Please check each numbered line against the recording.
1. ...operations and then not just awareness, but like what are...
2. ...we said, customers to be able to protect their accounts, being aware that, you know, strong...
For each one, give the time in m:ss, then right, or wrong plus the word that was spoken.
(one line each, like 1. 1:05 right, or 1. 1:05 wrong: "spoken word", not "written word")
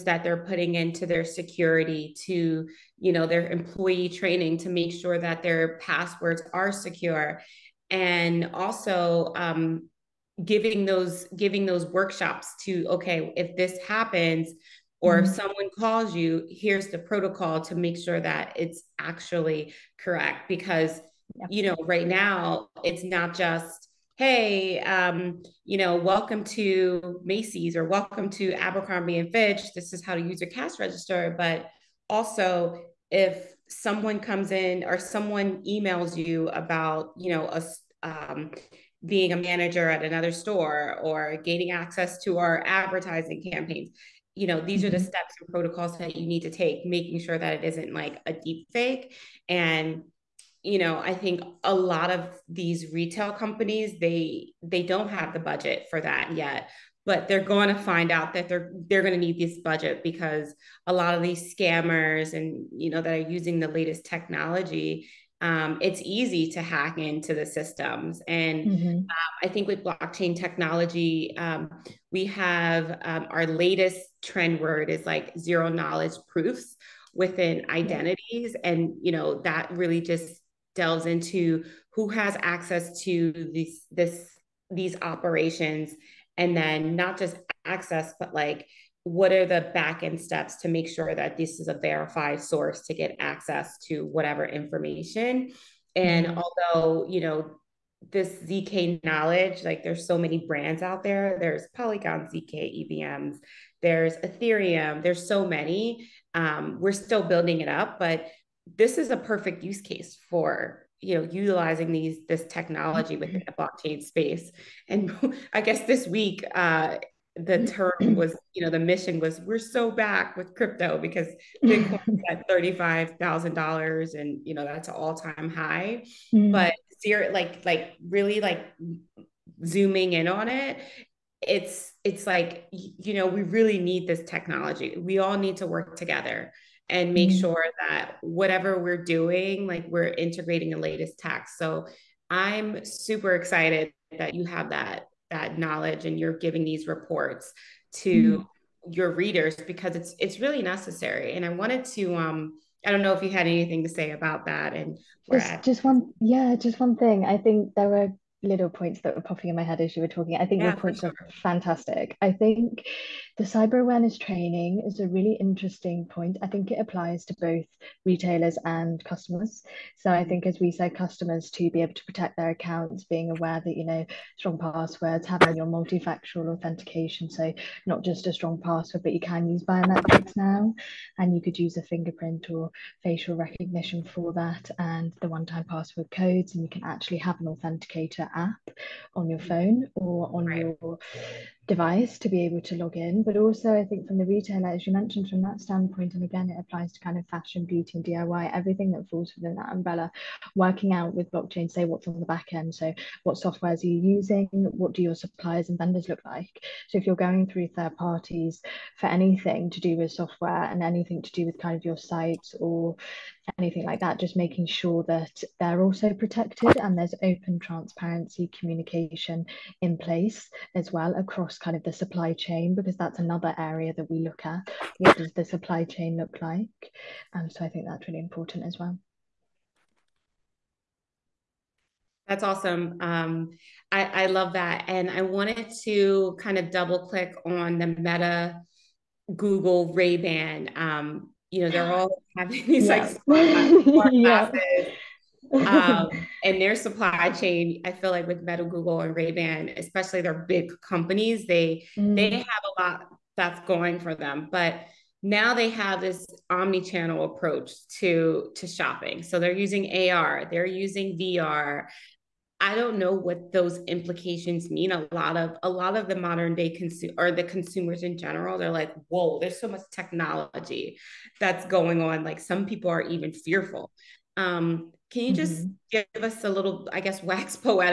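1. 1:25 wrong: "access", not "awareness"
2. 2:50 right.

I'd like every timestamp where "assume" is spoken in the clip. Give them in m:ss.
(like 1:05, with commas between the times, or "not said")
not said.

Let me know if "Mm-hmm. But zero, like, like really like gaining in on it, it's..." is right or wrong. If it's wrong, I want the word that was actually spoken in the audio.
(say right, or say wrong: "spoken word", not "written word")
wrong: "zooming", not "gaining".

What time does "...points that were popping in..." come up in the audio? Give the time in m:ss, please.
2:38.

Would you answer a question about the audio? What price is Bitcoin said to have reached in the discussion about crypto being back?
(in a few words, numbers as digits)
$35,000.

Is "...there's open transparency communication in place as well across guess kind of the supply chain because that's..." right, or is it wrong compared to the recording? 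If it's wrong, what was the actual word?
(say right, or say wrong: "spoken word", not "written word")
wrong: "across", not "guess".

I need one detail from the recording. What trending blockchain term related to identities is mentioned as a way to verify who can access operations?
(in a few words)
Zero knowledge proofs.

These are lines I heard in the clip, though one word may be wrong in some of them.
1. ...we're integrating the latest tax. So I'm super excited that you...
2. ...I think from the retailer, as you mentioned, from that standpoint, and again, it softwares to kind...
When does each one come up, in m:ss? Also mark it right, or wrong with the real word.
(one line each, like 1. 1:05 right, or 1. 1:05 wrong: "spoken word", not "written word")
1. 2:19 right
2. 3:13 wrong: "applies", not "softwares".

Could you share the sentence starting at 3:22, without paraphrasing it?
So, what softwares are you using?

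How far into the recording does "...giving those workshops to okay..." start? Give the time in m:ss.
0:11.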